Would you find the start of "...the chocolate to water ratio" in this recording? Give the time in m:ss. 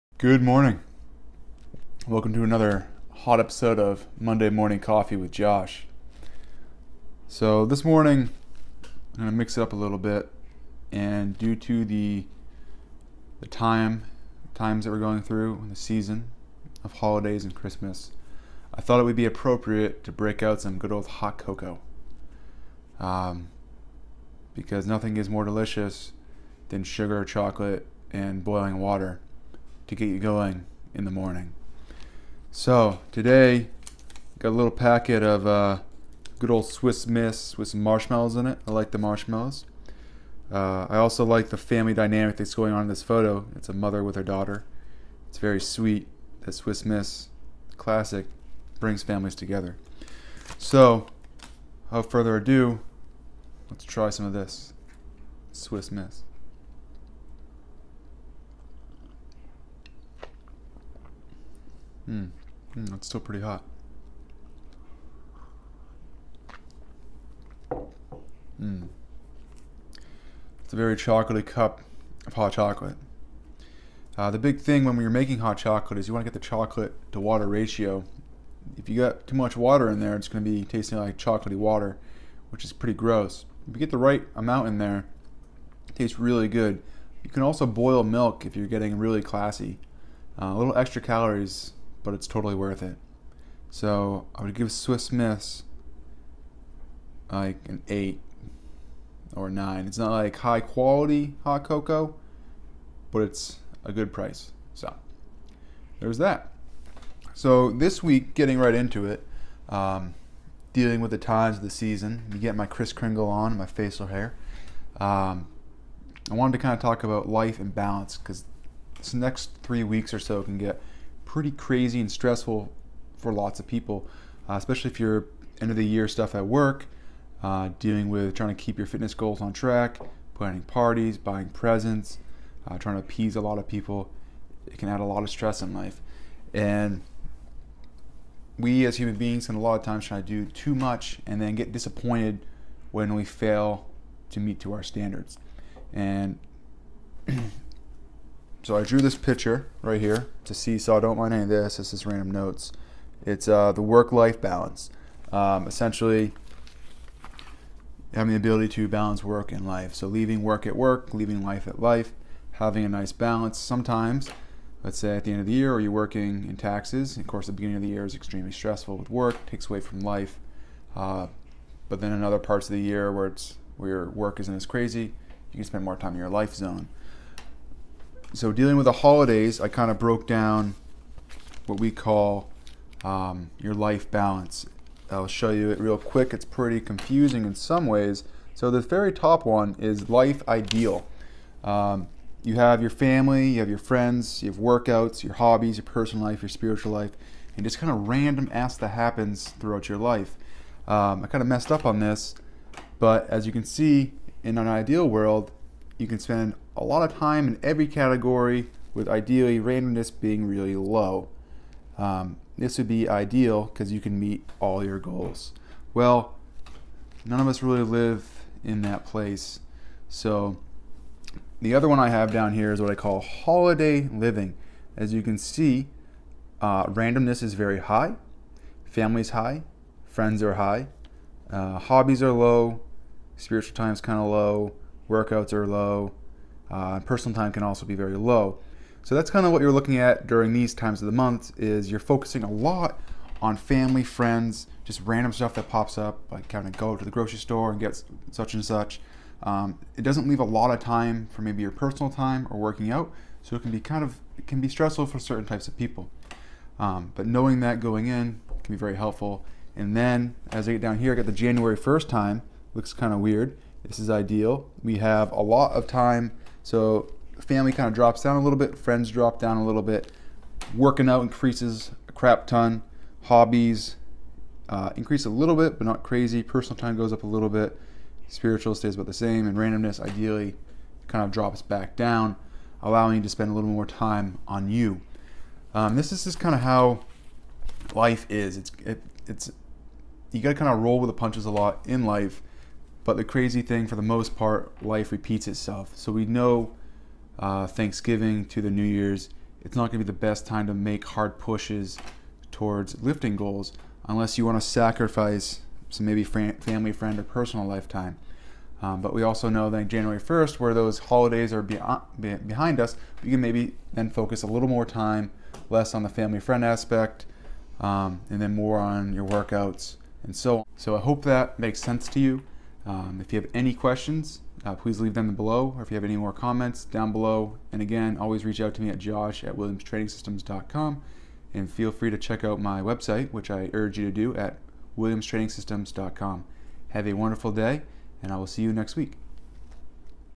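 1:16.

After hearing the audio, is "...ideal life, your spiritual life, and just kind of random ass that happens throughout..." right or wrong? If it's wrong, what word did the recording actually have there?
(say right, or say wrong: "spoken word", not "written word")
wrong: "personal", not "ideal".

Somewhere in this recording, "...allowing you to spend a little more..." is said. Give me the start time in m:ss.
4:42.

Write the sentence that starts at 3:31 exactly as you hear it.
Um, this would be ideal because you can meet all your goals.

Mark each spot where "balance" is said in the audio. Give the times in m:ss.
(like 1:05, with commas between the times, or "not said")
1:57, 2:34, 2:38, 2:43, 3:04.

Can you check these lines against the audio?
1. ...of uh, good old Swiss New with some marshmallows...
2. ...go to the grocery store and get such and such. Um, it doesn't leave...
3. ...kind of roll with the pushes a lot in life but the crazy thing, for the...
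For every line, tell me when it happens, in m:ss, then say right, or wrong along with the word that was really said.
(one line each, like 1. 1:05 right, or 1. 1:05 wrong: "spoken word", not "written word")
1. 0:35 wrong: "Miss", not "New"
2. 4:06 right
3. 4:50 wrong: "punches", not "pushes".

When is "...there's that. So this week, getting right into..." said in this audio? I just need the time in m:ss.
1:45.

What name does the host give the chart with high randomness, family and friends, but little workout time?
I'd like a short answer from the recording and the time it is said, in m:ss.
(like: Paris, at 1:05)
Holiday living, at 3:43.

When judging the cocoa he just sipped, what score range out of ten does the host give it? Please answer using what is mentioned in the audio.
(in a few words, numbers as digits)
8 or 9.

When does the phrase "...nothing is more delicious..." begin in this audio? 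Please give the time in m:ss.
0:24.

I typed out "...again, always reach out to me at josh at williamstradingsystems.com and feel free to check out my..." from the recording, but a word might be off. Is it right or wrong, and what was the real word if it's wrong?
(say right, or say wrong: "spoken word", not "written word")
right.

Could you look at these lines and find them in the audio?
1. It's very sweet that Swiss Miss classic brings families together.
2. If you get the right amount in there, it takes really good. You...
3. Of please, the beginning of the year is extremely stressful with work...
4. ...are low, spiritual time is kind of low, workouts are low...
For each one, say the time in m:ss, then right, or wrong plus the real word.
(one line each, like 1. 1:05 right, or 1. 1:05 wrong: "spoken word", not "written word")
1. 0:45 right
2. 1:23 wrong: "tastes", not "takes"
3. 2:47 wrong: "course", not "please"
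4. 3:52 right.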